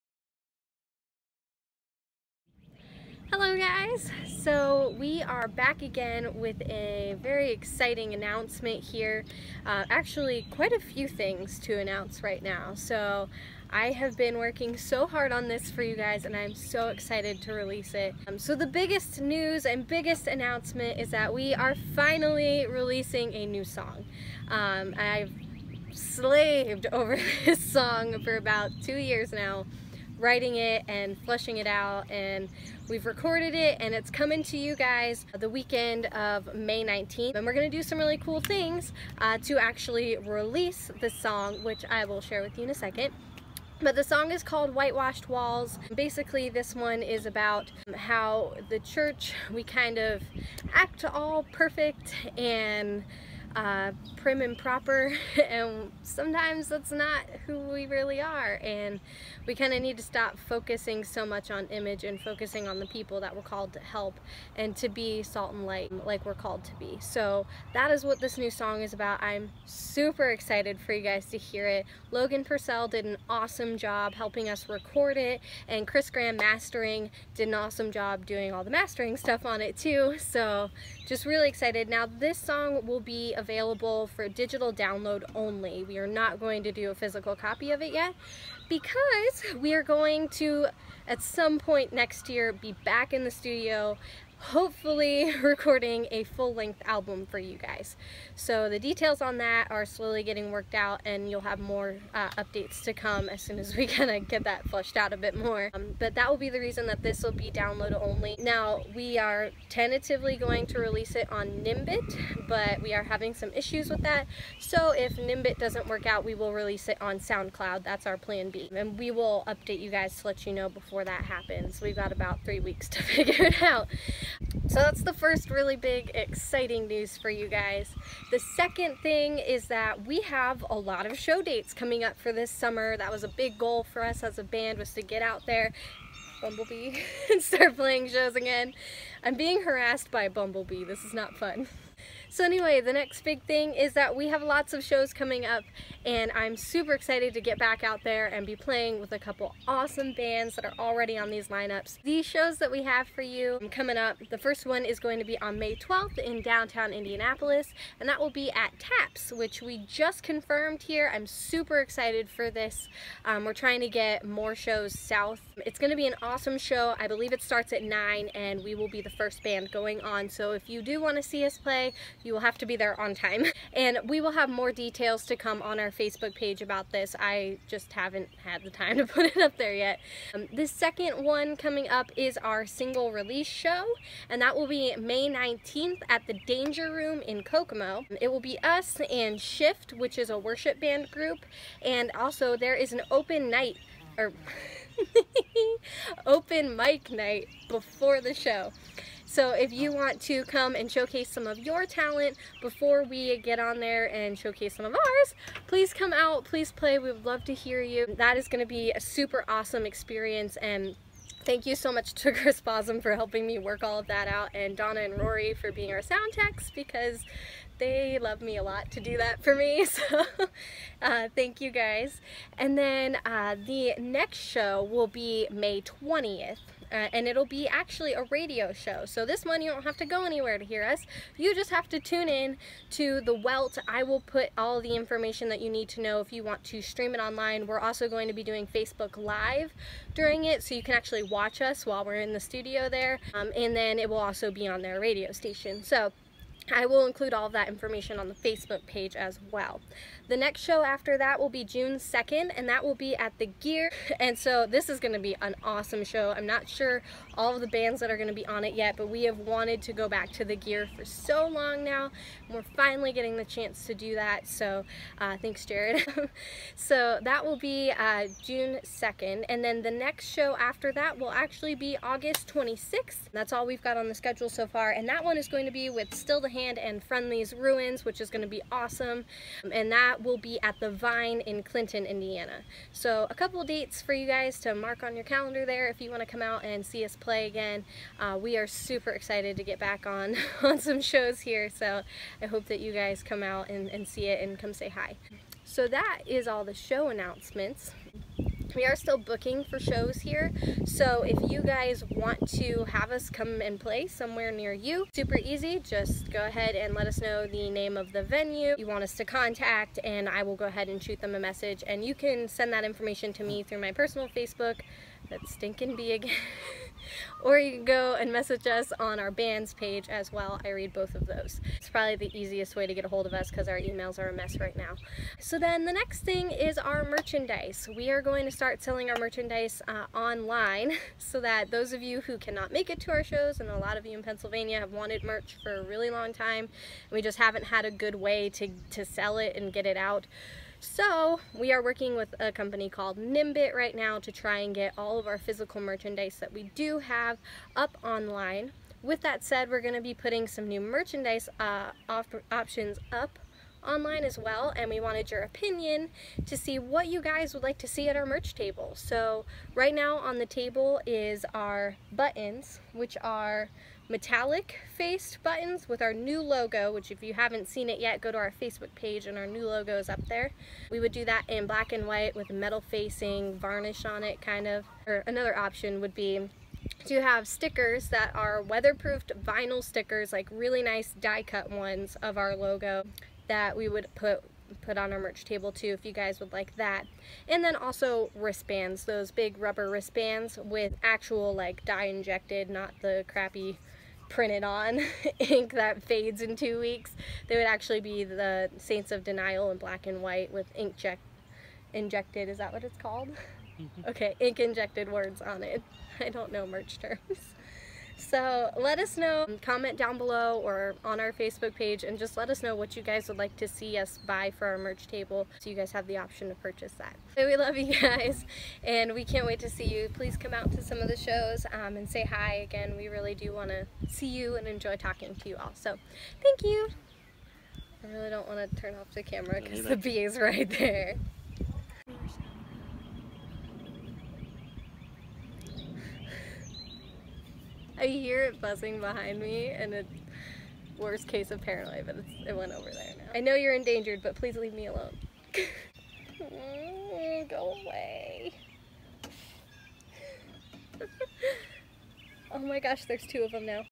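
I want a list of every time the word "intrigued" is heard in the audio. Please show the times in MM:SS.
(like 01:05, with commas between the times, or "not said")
not said.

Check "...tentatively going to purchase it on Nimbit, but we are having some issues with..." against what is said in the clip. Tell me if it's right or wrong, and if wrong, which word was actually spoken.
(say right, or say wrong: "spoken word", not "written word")
wrong: "release", not "purchase".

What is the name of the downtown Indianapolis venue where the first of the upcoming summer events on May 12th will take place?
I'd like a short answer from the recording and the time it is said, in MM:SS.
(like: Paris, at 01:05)
TAPS, at 02:38.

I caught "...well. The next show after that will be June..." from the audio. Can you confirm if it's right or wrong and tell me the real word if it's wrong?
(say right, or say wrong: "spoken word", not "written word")
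right.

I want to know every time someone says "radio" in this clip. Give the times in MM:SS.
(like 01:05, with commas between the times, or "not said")
03:48, 04:04.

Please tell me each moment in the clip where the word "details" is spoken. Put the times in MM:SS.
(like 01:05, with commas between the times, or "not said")
01:38, 02:54.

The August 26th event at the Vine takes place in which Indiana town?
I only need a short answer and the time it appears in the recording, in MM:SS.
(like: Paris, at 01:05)
Clinton, at 04:41.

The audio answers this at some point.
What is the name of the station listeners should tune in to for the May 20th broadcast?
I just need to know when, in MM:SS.
03:53.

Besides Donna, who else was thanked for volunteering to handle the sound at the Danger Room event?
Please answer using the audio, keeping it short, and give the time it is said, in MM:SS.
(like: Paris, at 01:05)
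Rory, at 03:35.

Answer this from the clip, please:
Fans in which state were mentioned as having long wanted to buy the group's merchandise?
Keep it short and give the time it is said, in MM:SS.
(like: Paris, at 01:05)
Pennsylvania, at 05:34.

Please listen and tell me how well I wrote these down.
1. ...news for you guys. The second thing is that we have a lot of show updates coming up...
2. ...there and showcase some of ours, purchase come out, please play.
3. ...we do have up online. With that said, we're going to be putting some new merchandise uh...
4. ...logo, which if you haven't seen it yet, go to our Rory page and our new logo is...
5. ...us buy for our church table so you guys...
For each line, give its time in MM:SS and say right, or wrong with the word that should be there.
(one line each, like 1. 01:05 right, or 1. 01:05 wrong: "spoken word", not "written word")
1. 02:06 wrong: "dates", not "updates"
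2. 03:23 wrong: "please", not "purchase"
3. 05:46 right
4. 06:06 wrong: "Facebook", not "Rory"
5. 06:53 wrong: "merch", not "church".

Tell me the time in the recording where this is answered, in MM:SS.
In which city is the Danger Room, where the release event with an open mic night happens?
03:07.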